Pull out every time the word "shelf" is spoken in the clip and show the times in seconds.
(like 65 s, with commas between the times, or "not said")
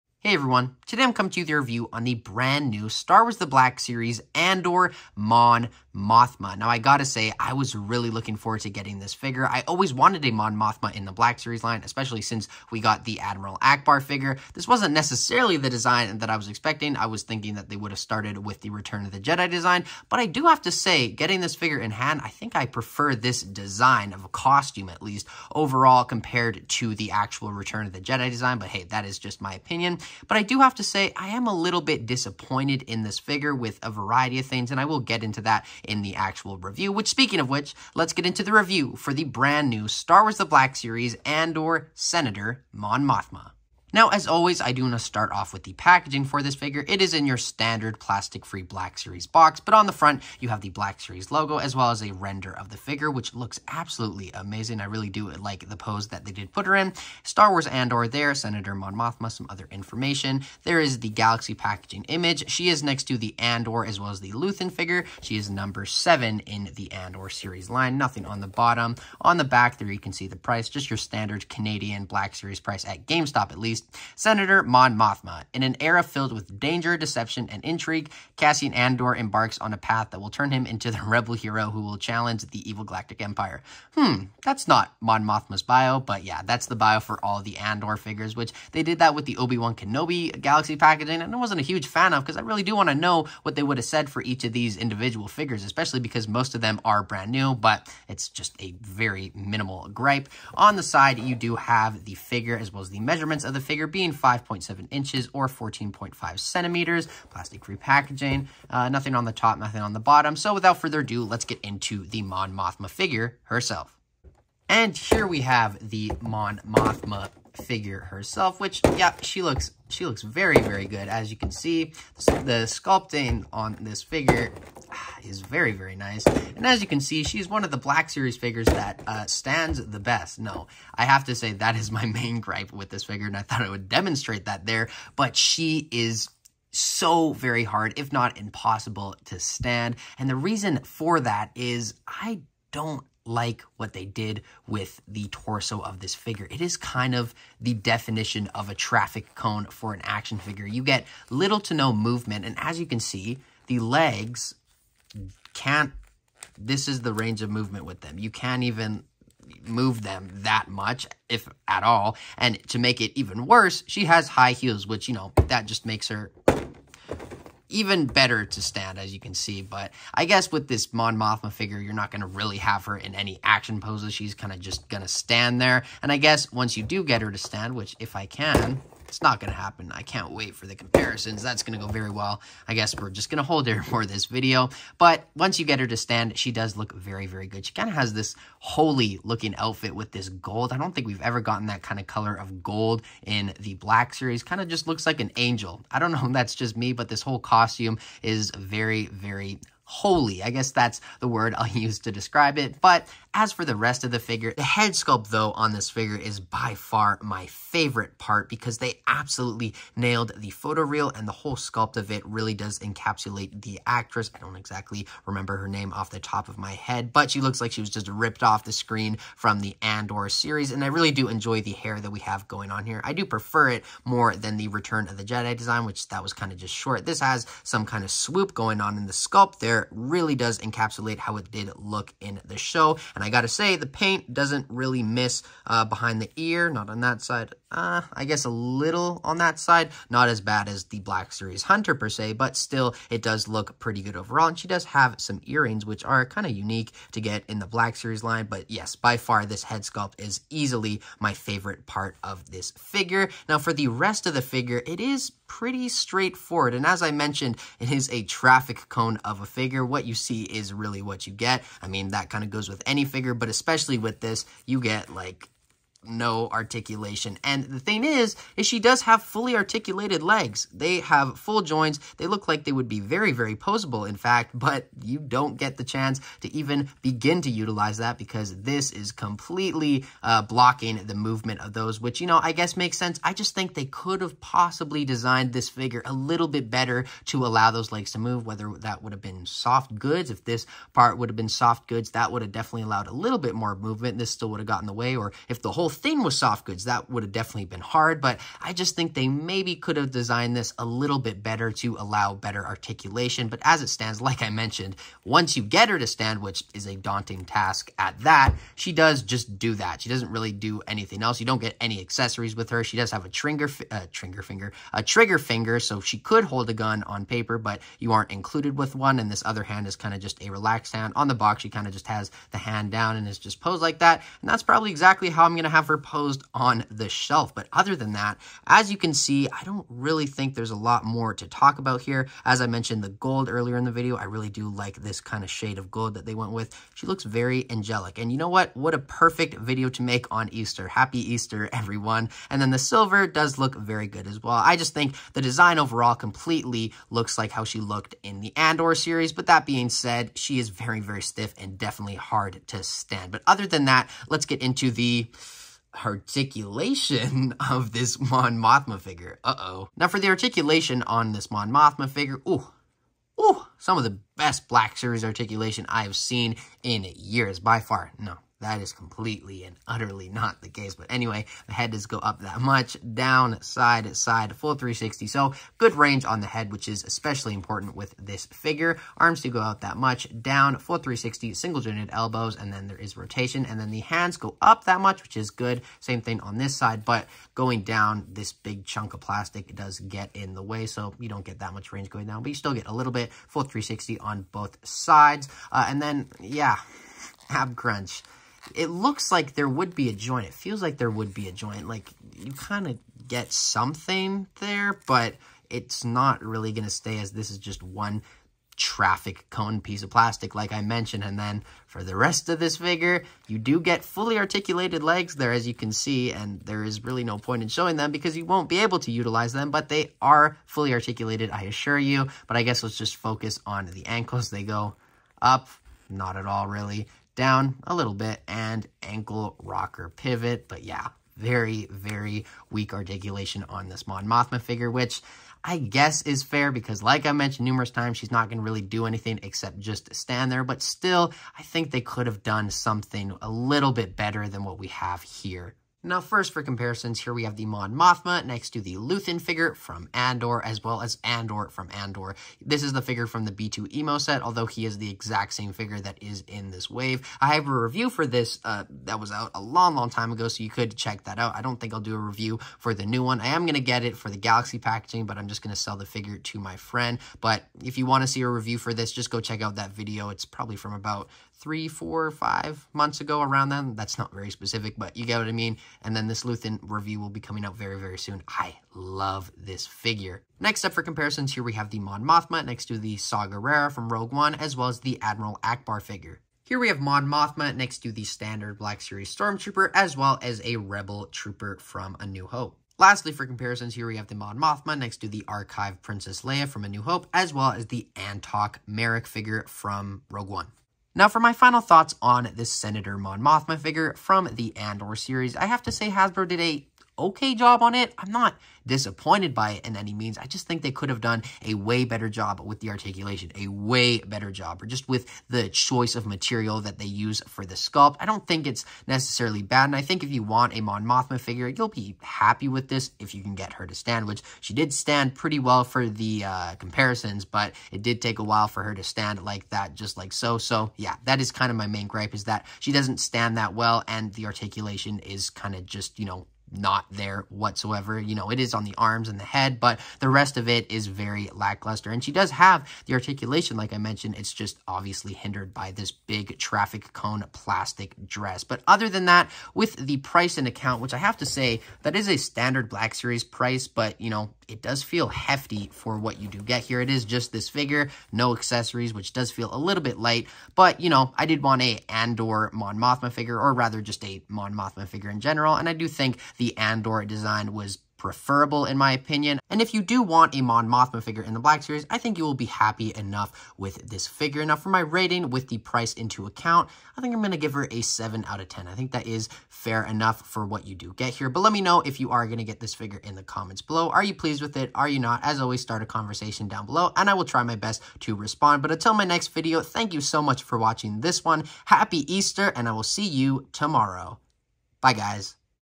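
327 s.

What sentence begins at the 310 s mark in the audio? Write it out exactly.
She doesn't really do anything else.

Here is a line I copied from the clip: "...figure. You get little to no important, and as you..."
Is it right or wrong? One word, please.
wrong.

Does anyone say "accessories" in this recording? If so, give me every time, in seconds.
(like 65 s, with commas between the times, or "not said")
311 s, 558 s.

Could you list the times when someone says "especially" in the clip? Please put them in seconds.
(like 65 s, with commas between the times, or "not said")
11 s, 95 s, 263 s, 377 s.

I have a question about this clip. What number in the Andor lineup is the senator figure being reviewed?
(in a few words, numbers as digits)
7.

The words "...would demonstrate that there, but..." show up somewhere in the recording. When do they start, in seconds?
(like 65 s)
133 s.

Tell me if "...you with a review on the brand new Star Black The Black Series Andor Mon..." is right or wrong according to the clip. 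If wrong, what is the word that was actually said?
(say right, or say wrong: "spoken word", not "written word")
wrong: "Wars", not "Black".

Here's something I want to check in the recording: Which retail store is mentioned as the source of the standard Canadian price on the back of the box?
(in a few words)
GameStop.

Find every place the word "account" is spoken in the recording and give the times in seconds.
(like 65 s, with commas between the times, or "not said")
550 s, 576 s.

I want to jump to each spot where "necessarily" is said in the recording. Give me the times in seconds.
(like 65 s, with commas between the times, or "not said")
14 s, 519 s.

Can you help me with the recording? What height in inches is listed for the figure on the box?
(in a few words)
5.7 inches.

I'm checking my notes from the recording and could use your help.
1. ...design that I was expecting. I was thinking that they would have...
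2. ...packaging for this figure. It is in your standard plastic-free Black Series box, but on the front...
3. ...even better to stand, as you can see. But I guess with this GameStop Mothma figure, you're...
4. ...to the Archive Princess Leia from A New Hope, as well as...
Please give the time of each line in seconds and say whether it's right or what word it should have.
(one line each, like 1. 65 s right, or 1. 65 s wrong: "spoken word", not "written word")
1. 15 s right
2. 45 s right
3. 167 s wrong: "Mon", not "GameStop"
4. 495 s right.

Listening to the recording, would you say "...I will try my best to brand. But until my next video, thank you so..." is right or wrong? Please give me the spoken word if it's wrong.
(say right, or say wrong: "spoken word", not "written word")
wrong: "respond", not "brand".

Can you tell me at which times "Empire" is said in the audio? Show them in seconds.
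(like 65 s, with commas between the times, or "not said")
83 s.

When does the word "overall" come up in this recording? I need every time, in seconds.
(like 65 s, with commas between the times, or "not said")
25 s, 244 s, 345 s.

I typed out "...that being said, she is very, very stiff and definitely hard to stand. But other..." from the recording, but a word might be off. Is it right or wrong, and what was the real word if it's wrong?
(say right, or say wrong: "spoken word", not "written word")
right.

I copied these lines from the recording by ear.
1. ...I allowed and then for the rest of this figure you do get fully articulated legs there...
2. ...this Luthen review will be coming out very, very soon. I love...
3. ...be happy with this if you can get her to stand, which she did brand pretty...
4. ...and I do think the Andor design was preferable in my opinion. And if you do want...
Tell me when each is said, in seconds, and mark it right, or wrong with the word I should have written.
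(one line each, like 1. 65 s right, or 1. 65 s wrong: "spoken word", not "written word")
1. 410 s wrong: "mentioned", not "allowed"
2. 476 s right
3. 521 s wrong: "stand", not "brand"
4. 565 s right.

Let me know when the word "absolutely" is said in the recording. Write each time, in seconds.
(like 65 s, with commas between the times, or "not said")
53 s, 209 s.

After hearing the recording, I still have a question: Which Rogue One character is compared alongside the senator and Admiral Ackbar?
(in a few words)
Saw Gerrera.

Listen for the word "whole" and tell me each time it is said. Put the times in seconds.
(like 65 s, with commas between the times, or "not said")
197 s, 211 s, 295 s.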